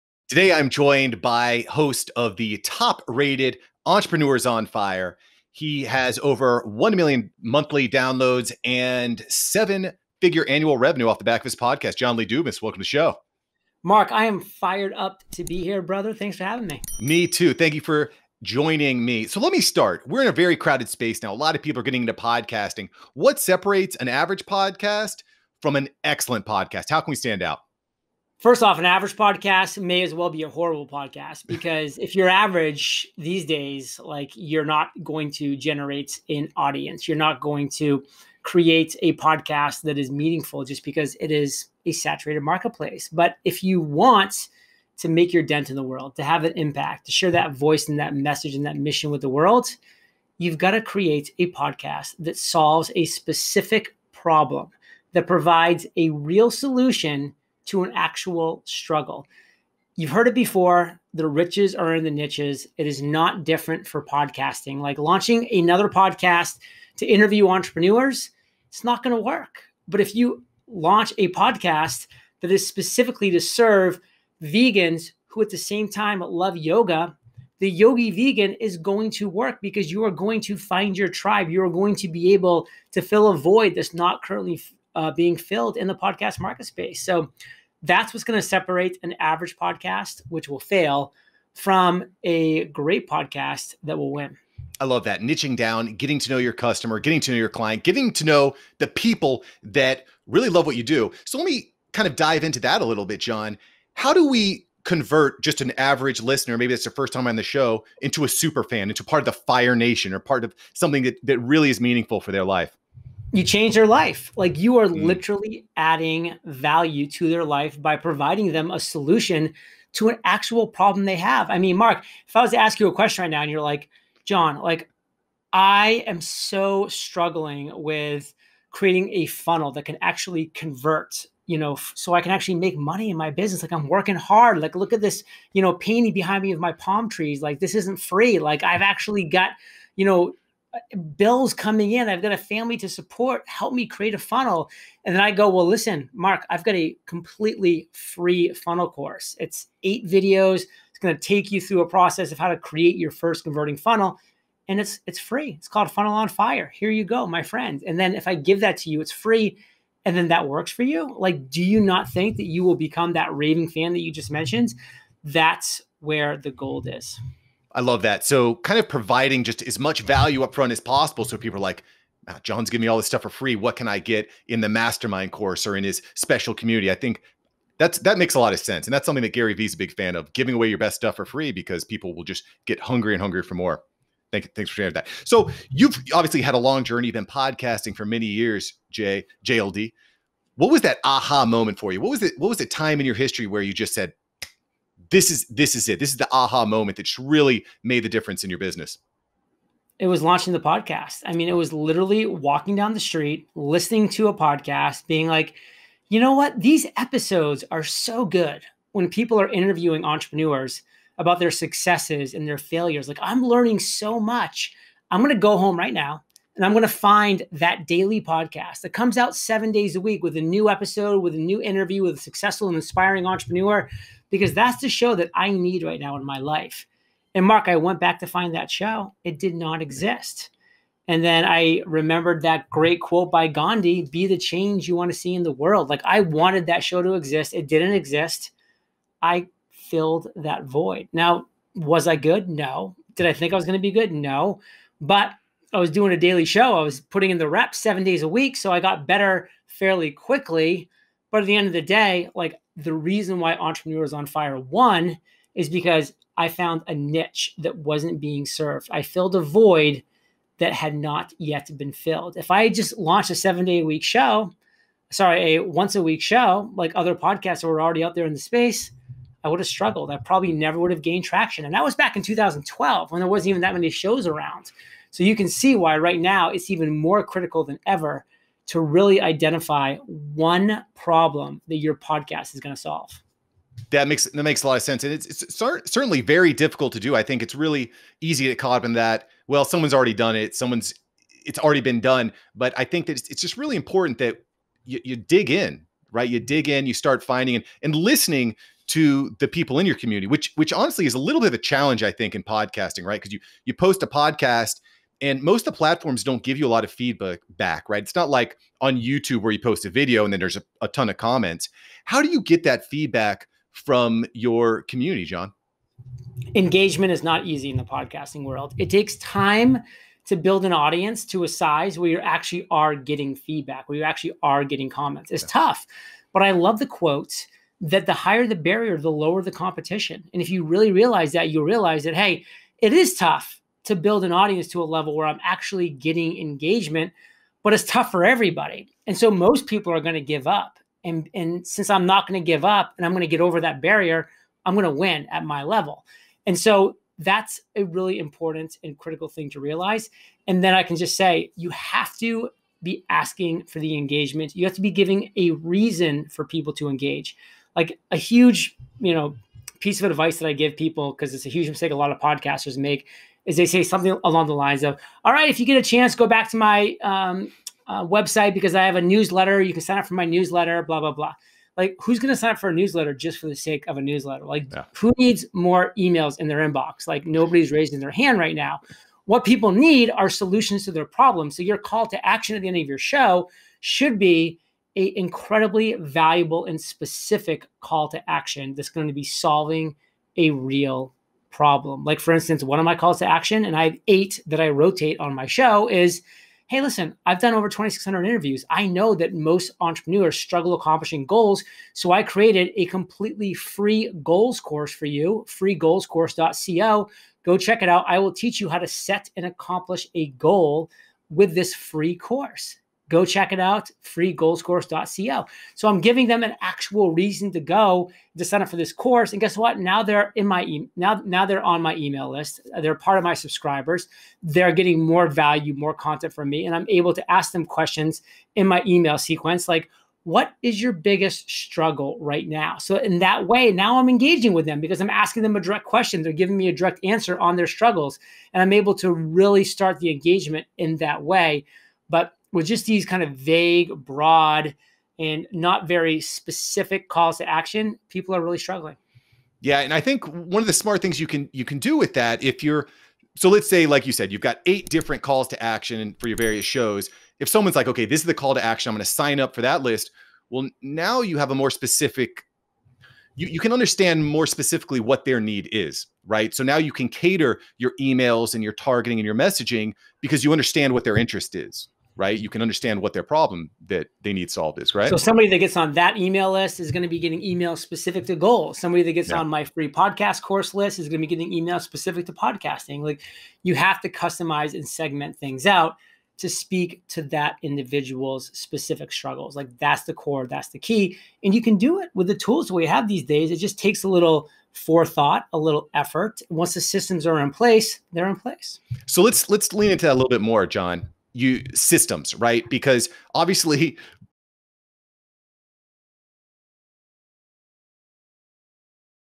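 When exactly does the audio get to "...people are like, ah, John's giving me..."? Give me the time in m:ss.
2:51.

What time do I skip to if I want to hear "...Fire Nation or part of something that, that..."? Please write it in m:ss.
1:49.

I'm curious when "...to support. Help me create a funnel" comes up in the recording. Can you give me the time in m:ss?
2:22.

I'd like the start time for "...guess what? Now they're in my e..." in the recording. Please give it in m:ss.
6:59.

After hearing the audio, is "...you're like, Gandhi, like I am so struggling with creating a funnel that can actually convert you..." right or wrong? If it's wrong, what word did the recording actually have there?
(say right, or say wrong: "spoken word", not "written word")
wrong: "John", not "Gandhi".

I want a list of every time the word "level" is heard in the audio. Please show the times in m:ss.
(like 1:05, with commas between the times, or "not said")
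5:34, 5:45.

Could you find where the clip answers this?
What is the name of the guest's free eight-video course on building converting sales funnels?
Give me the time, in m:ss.
2:35.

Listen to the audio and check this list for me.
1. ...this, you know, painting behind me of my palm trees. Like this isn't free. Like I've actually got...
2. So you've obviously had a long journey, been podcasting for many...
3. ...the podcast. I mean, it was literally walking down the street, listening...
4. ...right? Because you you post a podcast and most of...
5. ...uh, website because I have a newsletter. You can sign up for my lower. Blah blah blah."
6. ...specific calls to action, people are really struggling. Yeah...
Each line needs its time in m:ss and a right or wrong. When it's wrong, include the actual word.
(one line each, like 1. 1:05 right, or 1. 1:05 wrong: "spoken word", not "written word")
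1. 2:15 right
2. 3:05 right
3. 3:20 right
4. 5:03 right
5. 6:07 wrong: "newsletter", not "lower"
6. 7:26 right.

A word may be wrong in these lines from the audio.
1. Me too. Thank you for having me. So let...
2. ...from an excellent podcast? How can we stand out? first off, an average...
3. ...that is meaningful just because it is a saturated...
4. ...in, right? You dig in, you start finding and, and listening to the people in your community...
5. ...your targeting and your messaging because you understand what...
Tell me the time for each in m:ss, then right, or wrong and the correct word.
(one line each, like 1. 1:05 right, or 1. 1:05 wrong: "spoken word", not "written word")
1. 0:17 wrong: "joining", not "having"
2. 0:25 right
3. 0:39 right
4. 4:55 right
5. 7:48 right.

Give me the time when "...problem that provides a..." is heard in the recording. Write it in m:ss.
0:54.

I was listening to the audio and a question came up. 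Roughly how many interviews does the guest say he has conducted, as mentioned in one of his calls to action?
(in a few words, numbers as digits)
over 2,600.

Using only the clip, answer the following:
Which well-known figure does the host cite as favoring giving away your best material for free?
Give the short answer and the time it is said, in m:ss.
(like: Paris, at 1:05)
Gary Vee, at 2:59.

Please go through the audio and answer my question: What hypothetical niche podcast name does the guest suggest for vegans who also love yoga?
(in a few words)
The Yogi Vegan.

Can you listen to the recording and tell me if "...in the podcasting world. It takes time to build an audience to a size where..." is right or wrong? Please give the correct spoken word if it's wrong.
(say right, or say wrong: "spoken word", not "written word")
right.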